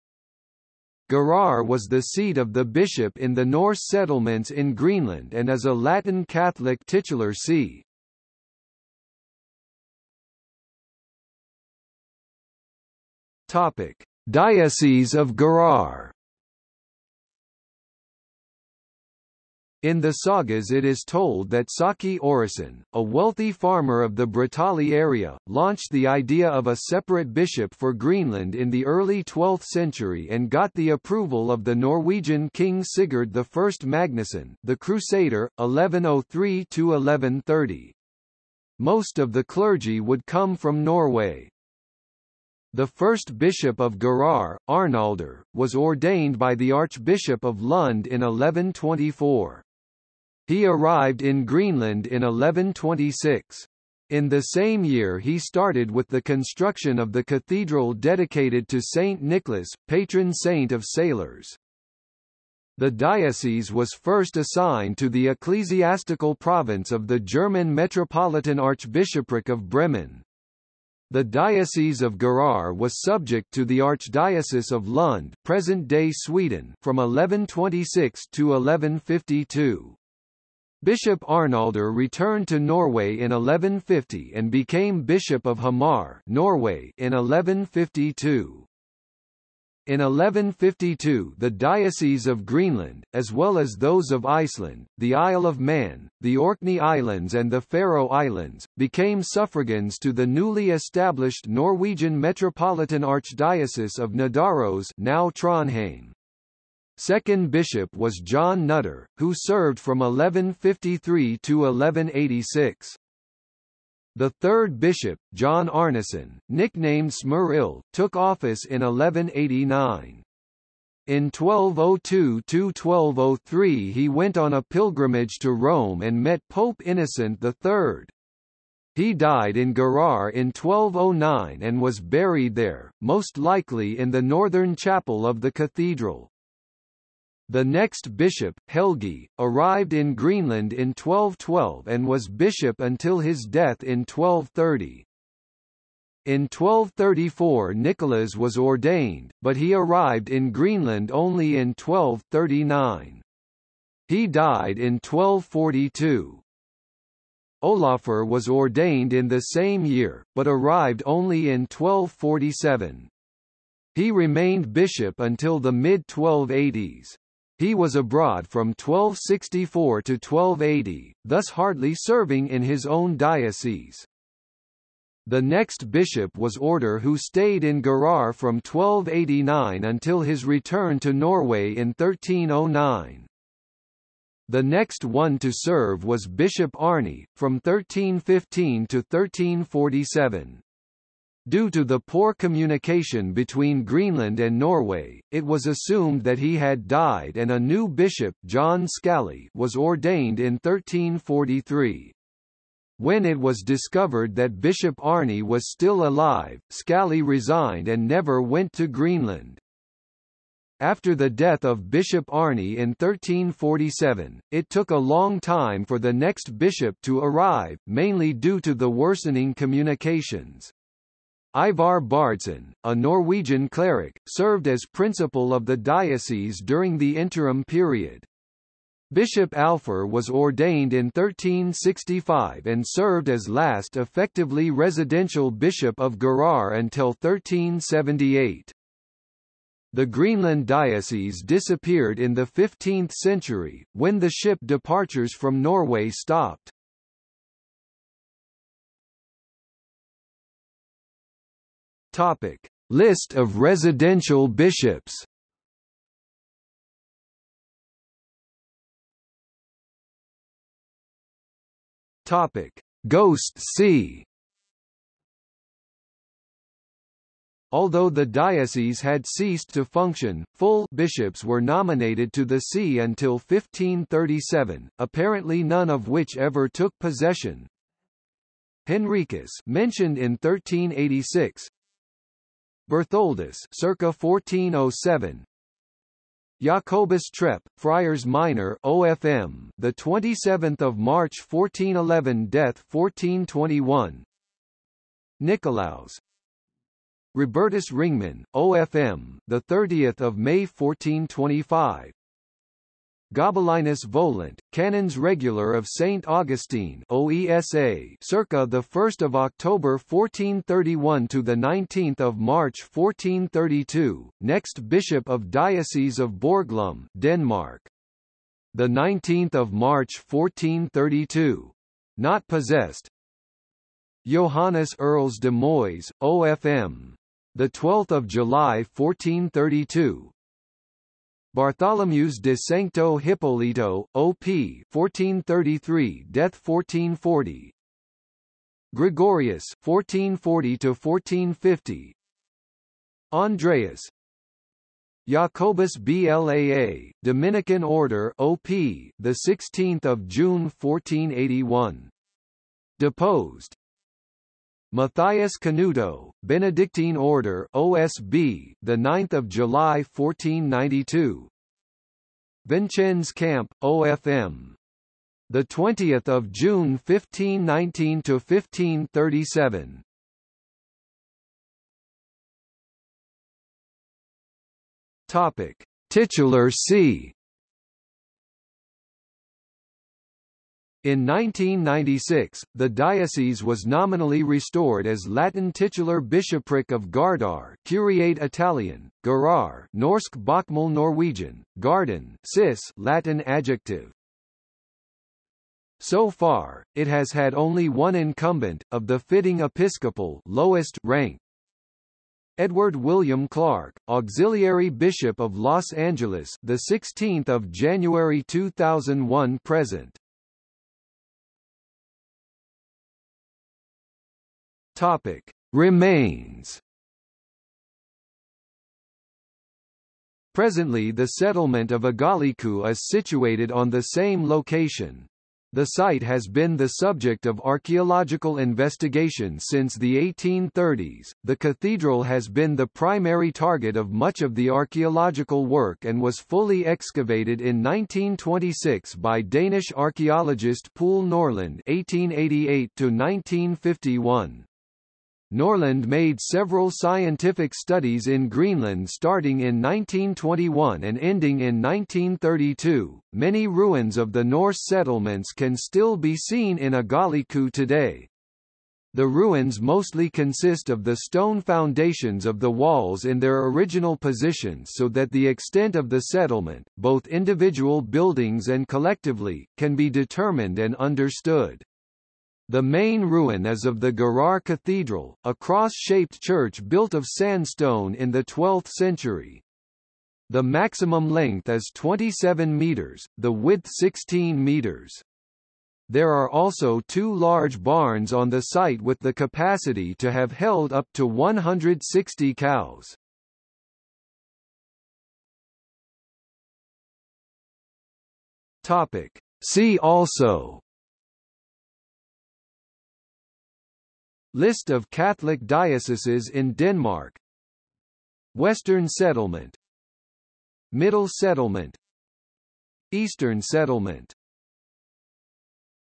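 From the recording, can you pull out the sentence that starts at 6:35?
So far, it has had only one incumbent, of the fitting episcopal lowest rank.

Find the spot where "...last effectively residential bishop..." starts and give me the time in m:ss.
3:53.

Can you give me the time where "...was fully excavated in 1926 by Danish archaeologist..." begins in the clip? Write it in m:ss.
7:16.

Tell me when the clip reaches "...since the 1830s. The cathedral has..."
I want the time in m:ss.
7:09.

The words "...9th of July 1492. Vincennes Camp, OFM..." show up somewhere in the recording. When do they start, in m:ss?
5:58.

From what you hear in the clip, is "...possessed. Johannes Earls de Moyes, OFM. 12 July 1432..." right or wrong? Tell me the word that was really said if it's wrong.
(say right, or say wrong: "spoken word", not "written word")
right.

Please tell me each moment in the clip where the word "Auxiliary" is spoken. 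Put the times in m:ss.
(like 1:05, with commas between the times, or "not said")
6:44.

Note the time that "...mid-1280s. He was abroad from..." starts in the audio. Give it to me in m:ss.
2:45.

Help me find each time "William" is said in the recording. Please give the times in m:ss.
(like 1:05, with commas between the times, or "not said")
6:42.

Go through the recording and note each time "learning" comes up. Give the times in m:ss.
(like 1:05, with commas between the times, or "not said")
not said.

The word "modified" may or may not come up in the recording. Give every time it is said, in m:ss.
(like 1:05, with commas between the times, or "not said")
not said.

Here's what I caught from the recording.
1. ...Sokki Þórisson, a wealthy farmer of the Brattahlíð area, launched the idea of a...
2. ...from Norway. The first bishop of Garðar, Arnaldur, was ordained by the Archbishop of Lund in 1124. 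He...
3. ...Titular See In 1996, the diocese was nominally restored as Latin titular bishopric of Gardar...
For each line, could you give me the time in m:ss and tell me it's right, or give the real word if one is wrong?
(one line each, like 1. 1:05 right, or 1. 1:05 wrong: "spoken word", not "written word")
1. 0:21 right
2. 0:40 right
3. 6:16 right.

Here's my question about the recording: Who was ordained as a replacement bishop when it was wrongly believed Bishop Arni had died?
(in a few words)
Jon Skalle.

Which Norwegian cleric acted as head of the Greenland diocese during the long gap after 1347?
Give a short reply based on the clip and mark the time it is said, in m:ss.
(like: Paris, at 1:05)
Ivar Bardsen, at 3:41.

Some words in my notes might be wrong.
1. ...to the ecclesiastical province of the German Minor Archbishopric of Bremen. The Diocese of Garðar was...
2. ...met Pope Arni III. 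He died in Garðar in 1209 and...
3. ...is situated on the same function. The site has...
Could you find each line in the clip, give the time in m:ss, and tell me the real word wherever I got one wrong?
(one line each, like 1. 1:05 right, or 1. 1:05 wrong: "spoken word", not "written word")
1. 1:04 wrong: "Metropolitan", not "Minor"
2. 2:06 wrong: "Innocent", not "Arni"
3. 7:02 wrong: "location", not "function".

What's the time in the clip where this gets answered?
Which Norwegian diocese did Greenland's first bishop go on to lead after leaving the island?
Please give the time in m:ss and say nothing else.
1:25.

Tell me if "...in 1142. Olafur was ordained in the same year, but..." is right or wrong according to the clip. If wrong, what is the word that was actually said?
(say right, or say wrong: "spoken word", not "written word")
wrong: "1242", not "1142".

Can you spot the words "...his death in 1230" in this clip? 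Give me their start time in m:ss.
2:23.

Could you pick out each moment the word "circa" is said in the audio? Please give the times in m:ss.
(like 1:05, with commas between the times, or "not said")
4:43, 5:08.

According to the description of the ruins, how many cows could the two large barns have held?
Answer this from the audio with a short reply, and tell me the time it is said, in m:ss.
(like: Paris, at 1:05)
160, at 8:11.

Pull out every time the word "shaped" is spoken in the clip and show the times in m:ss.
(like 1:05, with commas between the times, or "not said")
7:55.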